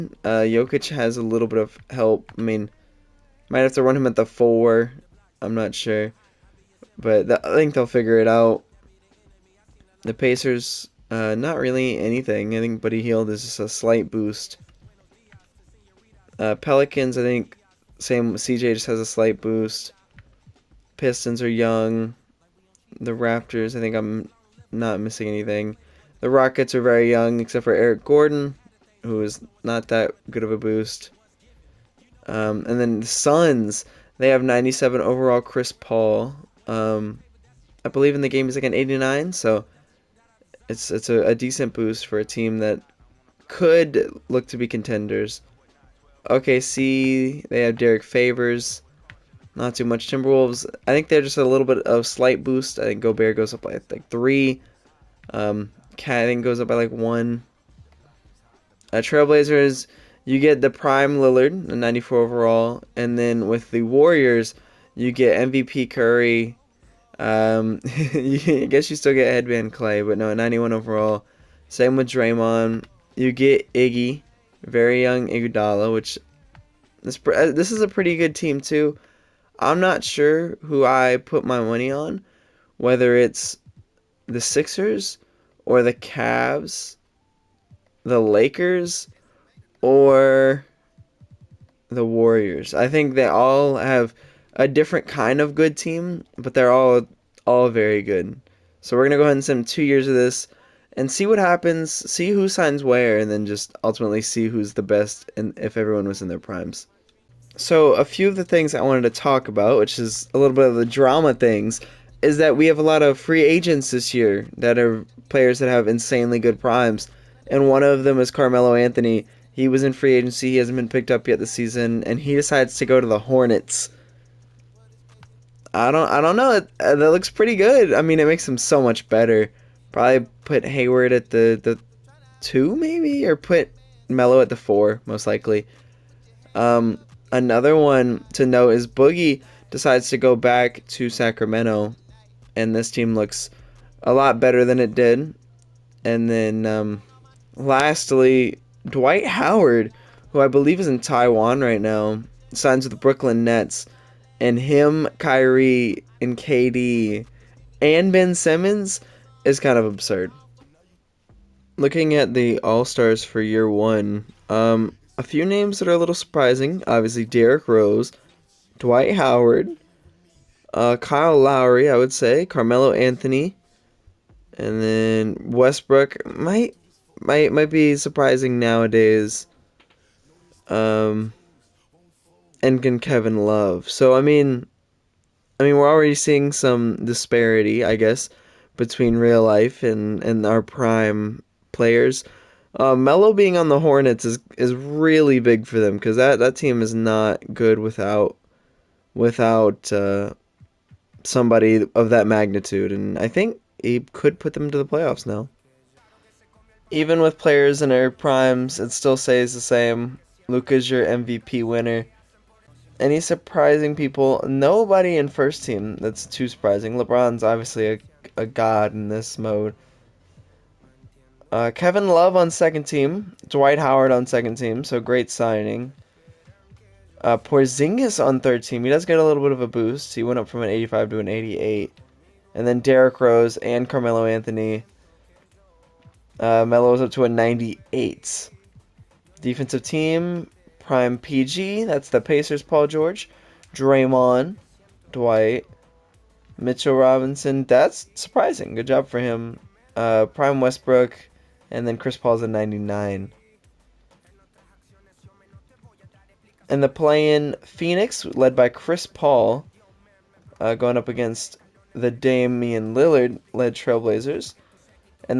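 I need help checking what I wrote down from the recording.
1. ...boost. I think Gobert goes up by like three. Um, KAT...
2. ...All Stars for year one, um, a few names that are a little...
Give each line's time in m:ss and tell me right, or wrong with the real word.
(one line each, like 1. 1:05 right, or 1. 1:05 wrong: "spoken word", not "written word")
1. 0:52 right
2. 2:42 right.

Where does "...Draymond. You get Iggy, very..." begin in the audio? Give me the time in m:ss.
1:12.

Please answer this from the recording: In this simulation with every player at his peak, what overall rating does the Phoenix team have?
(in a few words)
97.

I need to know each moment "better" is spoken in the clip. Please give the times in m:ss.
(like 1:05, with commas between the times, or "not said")
2:09, 2:24.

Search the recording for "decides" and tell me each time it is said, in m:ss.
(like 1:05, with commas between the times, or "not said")
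2:02, 2:19.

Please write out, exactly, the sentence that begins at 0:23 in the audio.
The Raptors, I think I'm not missing anything.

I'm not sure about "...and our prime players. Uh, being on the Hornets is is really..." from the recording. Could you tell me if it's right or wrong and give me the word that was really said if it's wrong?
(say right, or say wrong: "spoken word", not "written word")
right.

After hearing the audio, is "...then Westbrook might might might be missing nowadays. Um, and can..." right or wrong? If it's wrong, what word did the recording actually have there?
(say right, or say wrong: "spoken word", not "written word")
wrong: "surprising", not "missing".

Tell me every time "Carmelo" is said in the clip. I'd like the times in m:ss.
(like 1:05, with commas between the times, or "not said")
1:58, 2:52, 3:53.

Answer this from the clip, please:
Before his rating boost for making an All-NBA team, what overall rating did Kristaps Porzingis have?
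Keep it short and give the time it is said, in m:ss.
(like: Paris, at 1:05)
85, at 3:50.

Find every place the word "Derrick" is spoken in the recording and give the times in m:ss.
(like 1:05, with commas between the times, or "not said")
0:47, 2:47, 3:52.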